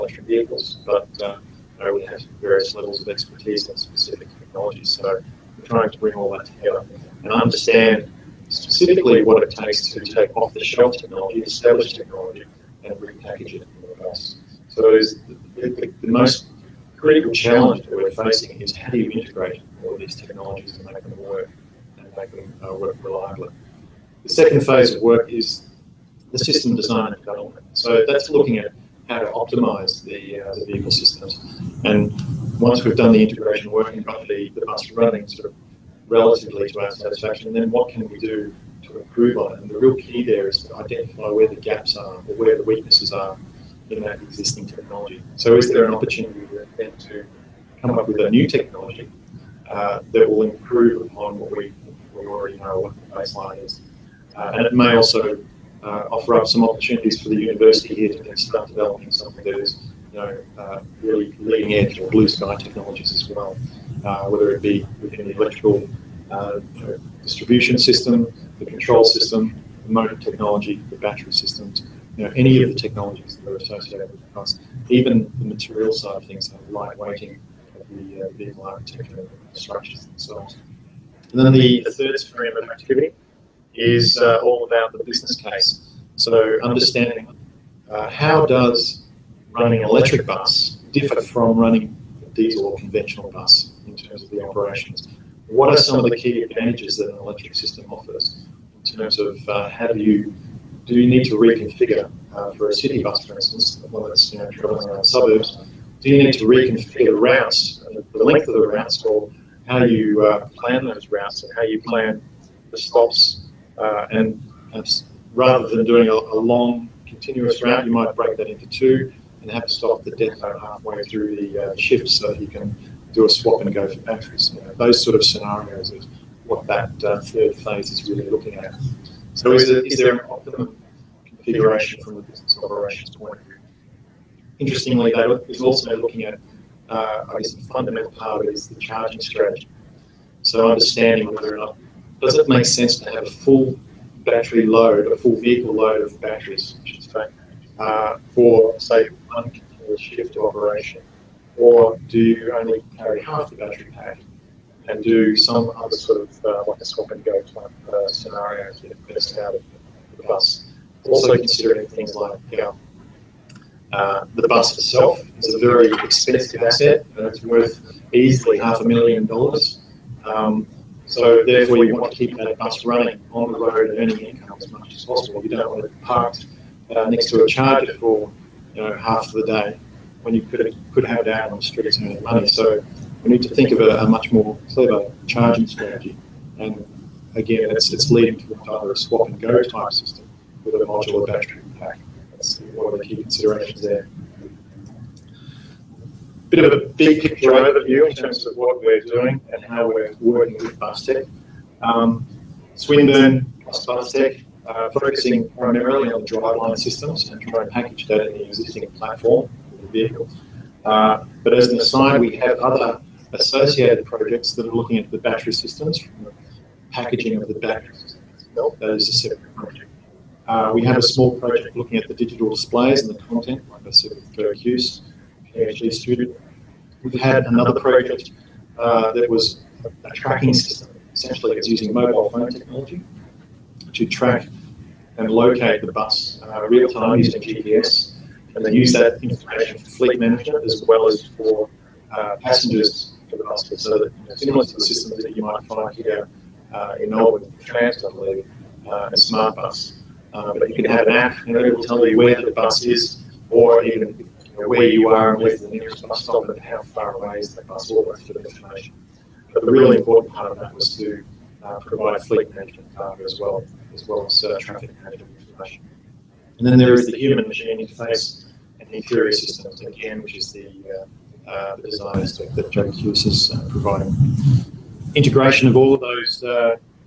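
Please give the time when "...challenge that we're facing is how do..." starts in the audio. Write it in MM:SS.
00:17.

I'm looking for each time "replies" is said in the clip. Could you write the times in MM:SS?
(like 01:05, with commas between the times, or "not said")
not said.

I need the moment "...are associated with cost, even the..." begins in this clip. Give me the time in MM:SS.
01:13.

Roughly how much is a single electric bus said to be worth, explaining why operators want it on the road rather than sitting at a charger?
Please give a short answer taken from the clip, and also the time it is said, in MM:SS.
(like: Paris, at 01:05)
half a million dollars, at 02:48.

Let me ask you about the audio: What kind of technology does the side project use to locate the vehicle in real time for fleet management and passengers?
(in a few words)
mobile phone technology.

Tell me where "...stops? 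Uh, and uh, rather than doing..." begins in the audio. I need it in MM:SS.
01:52.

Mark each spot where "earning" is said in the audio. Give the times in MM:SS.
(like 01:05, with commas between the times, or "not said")
02:53, 03:01.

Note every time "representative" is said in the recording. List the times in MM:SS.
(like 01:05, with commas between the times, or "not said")
not said.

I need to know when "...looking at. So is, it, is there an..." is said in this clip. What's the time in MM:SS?
02:08.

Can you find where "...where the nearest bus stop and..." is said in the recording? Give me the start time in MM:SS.
04:15.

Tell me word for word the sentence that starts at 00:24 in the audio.
The second phase of work is the system design and development.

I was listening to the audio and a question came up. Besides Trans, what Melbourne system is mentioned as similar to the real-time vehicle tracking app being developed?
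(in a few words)
Smart Bus.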